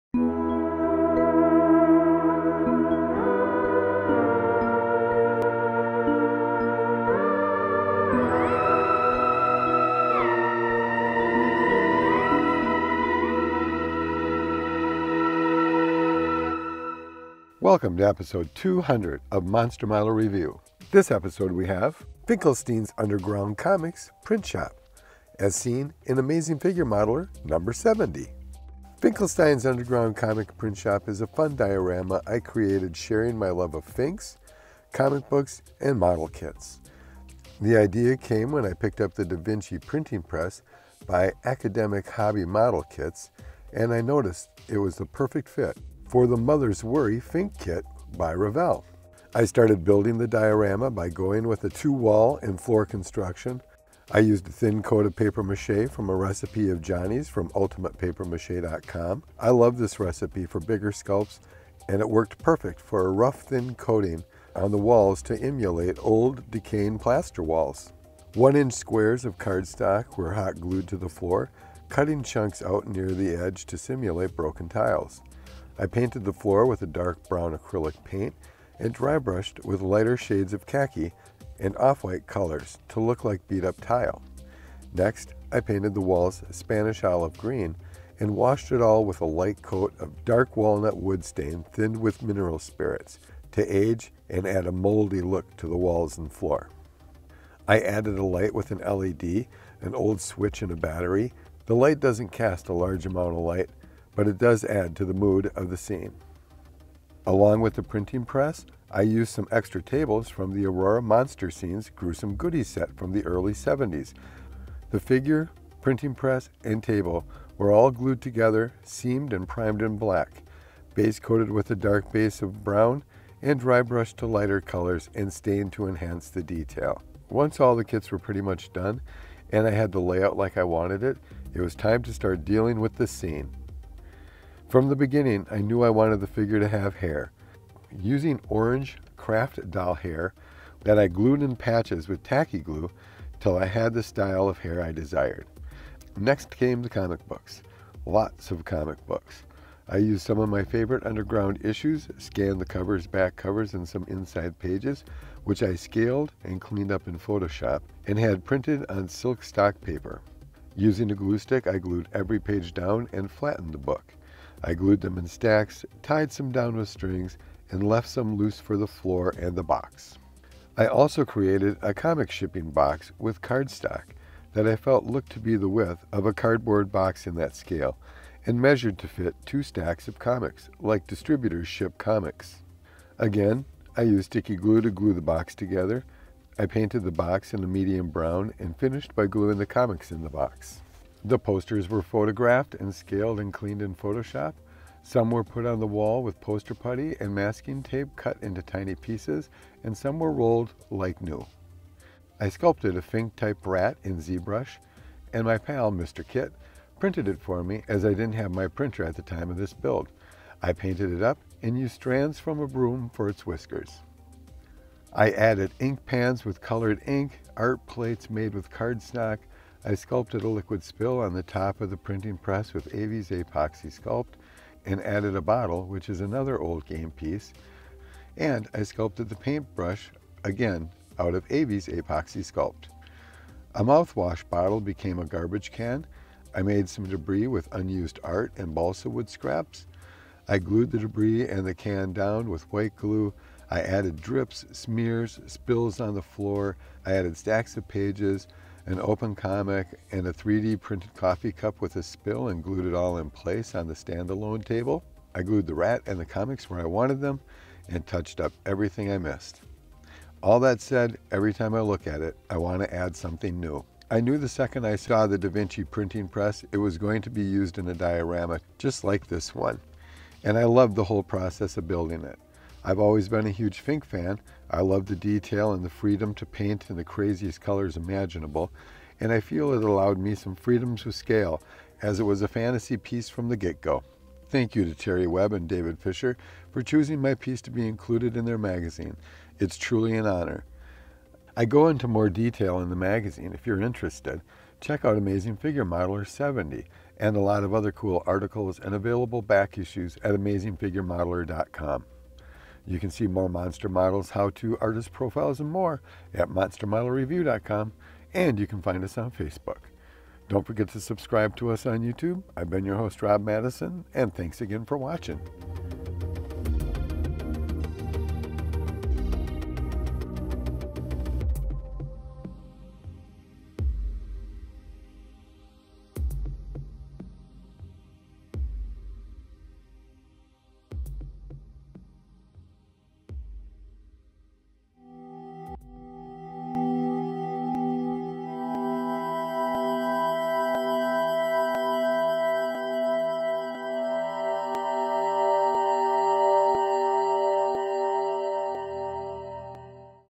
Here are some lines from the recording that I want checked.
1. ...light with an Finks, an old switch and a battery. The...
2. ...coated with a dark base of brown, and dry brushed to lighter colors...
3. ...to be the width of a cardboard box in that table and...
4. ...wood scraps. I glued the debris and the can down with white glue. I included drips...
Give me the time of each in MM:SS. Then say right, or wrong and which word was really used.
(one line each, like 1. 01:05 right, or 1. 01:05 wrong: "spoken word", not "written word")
1. 01:38 wrong: "LED", not "Finks"
2. 02:01 right
3. 02:55 wrong: "scale", not "table"
4. 03:59 wrong: "added", not "included".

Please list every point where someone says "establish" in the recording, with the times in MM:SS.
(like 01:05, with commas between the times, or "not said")
not said.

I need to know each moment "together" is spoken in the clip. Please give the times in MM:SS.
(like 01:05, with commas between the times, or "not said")
01:58, 03:05.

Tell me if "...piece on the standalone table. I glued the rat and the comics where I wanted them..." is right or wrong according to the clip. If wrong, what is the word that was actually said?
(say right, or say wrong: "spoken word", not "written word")
wrong: "place", not "piece".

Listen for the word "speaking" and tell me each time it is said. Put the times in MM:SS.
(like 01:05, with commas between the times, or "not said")
not said.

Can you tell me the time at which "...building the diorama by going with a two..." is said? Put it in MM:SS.
00:49.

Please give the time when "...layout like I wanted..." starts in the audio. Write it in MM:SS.
02:10.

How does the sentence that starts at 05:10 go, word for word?
Don't forget to subscribe to us on YouTube.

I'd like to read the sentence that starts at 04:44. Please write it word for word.
Thank you to Terry Webb and David Fisher for choosing my piece to be included in their magazine.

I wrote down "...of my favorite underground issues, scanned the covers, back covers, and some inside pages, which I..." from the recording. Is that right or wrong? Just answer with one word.
right.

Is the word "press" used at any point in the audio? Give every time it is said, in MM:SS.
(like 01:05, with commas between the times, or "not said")
00:40, 01:48, 01:56, 03:42, 04:26.